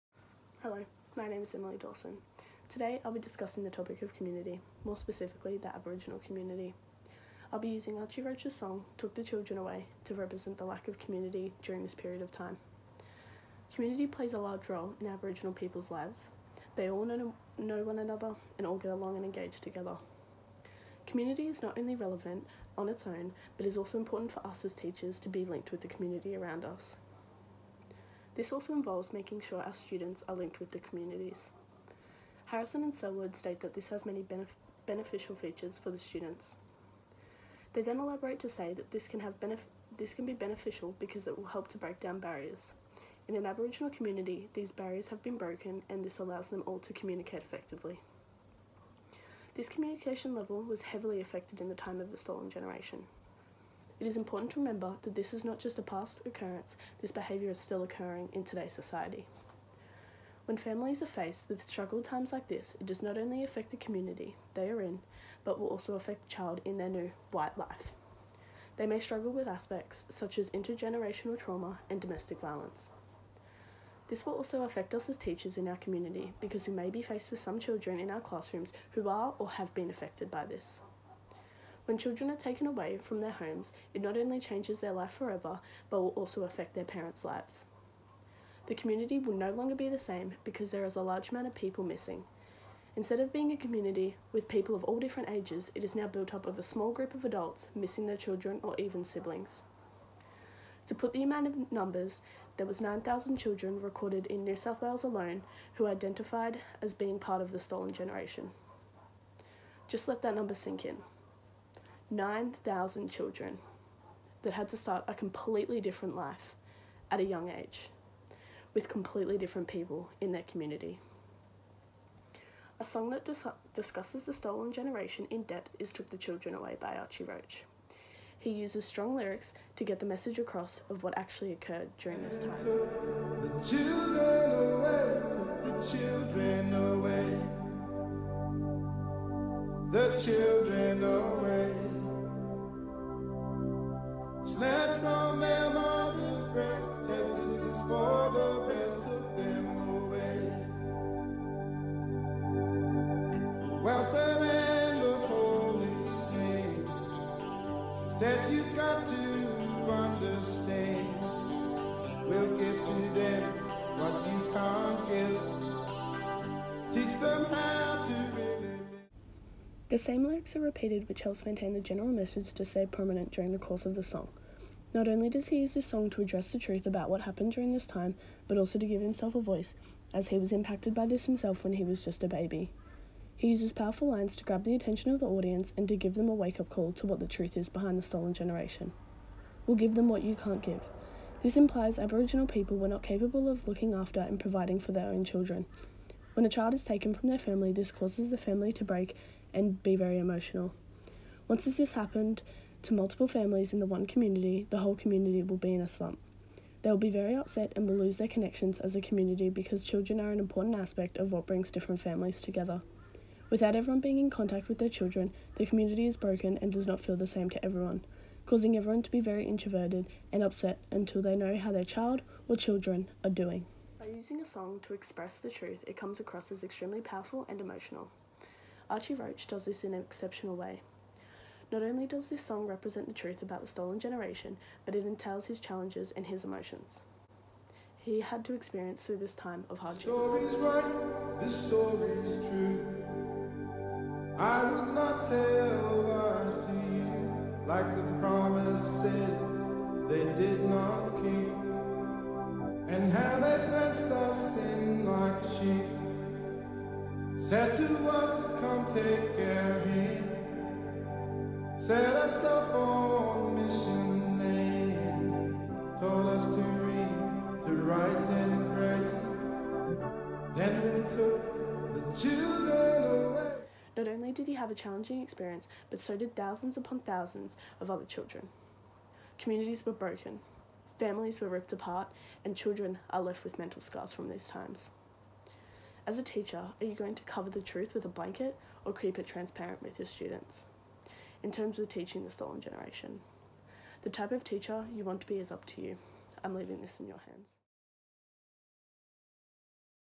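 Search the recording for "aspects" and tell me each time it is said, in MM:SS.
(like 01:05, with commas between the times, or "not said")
01:09, 03:30.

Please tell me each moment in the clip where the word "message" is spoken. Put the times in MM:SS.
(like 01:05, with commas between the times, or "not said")
02:10, 02:52.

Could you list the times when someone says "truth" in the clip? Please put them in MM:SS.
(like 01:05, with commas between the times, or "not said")
02:56, 03:07, 03:45, 03:53, 04:47.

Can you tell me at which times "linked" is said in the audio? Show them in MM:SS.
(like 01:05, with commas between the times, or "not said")
00:25, 00:30.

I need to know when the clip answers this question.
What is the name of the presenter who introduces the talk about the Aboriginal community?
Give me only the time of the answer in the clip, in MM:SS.
00:01.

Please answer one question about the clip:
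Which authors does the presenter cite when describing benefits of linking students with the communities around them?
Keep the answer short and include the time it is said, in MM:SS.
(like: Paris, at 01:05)
Harrison and Sellwood, at 00:32.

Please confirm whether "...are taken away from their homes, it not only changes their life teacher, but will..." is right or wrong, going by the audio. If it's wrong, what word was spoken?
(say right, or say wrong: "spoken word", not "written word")
wrong: "forever", not "teacher".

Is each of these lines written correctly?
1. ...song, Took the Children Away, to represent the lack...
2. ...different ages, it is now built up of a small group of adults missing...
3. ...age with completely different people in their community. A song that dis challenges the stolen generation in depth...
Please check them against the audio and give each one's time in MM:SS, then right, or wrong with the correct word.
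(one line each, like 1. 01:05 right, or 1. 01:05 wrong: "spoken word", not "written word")
1. 00:08 right
2. 01:35 right
3. 01:57 wrong: "discusses", not "challenges".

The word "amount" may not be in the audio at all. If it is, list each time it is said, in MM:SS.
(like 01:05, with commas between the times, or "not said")
01:31, 01:41.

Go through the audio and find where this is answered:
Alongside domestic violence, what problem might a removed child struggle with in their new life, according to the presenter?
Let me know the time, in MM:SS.
01:10.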